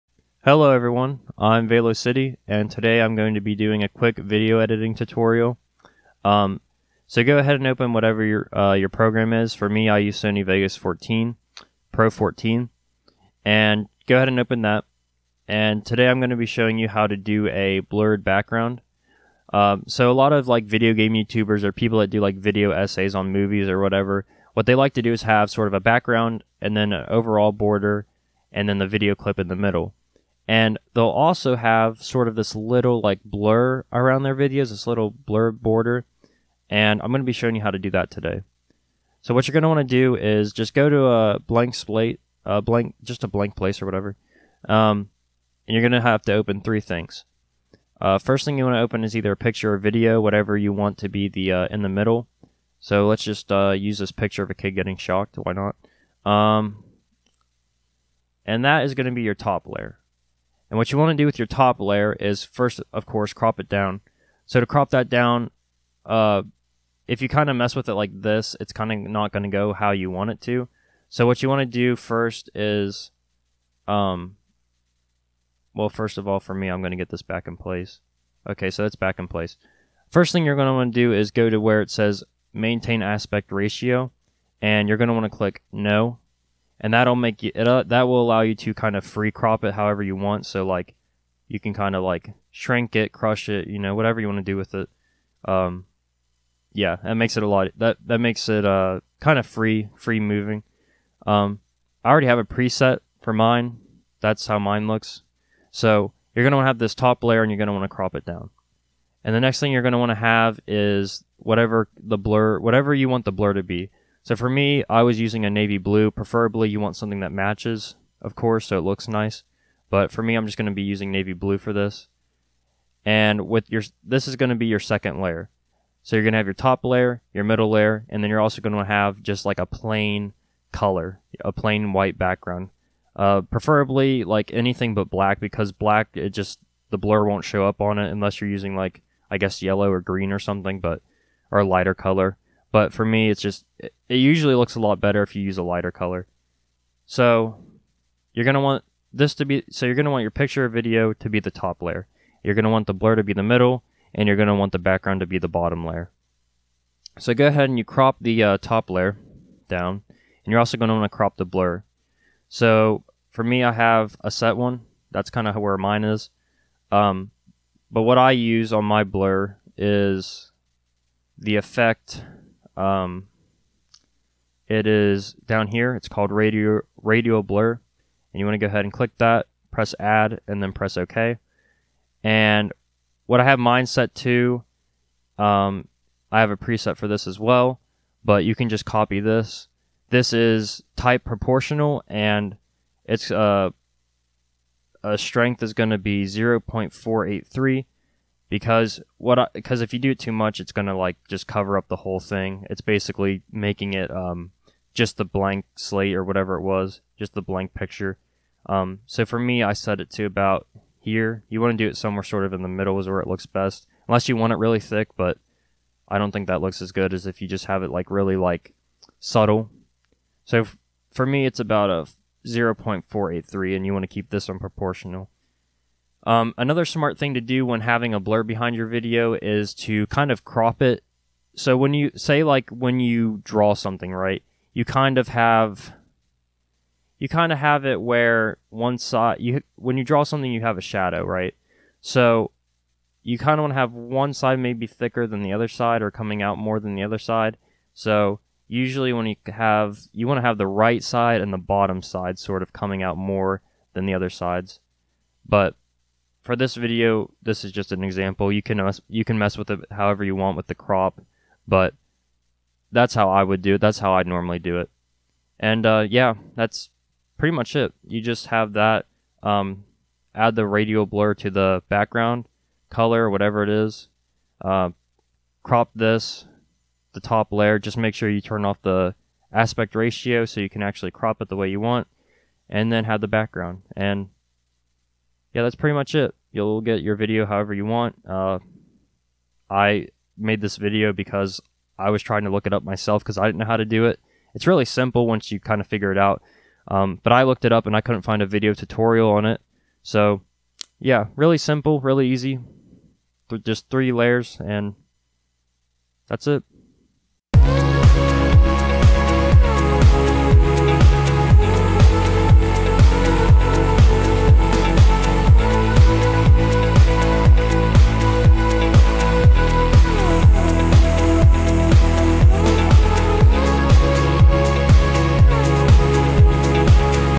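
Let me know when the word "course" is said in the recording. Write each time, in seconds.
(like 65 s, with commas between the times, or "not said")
63 s, 118 s.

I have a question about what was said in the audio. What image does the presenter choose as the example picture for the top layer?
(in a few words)
a kid getting shocked.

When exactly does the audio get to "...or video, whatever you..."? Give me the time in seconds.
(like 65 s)
49 s.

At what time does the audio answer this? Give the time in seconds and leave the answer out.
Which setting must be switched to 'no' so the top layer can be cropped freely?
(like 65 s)
82 s.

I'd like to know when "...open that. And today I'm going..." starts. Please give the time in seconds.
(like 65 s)
14 s.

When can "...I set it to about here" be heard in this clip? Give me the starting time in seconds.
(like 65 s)
209 s.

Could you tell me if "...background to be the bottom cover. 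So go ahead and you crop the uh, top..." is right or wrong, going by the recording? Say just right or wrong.
wrong.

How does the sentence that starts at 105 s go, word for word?
So you're gonna want to have this top layer, and you're gonna want to crop it down.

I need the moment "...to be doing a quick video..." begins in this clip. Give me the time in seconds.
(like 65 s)
3 s.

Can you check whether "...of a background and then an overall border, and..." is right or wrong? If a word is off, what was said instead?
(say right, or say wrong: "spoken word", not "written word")
right.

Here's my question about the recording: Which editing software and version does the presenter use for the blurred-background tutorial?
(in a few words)
Sony Vegas 14 Pro.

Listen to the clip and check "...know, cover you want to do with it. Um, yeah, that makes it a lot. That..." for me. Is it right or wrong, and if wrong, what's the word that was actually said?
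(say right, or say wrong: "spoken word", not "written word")
wrong: "whatever", not "cover".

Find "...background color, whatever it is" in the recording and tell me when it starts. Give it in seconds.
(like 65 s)
271 s.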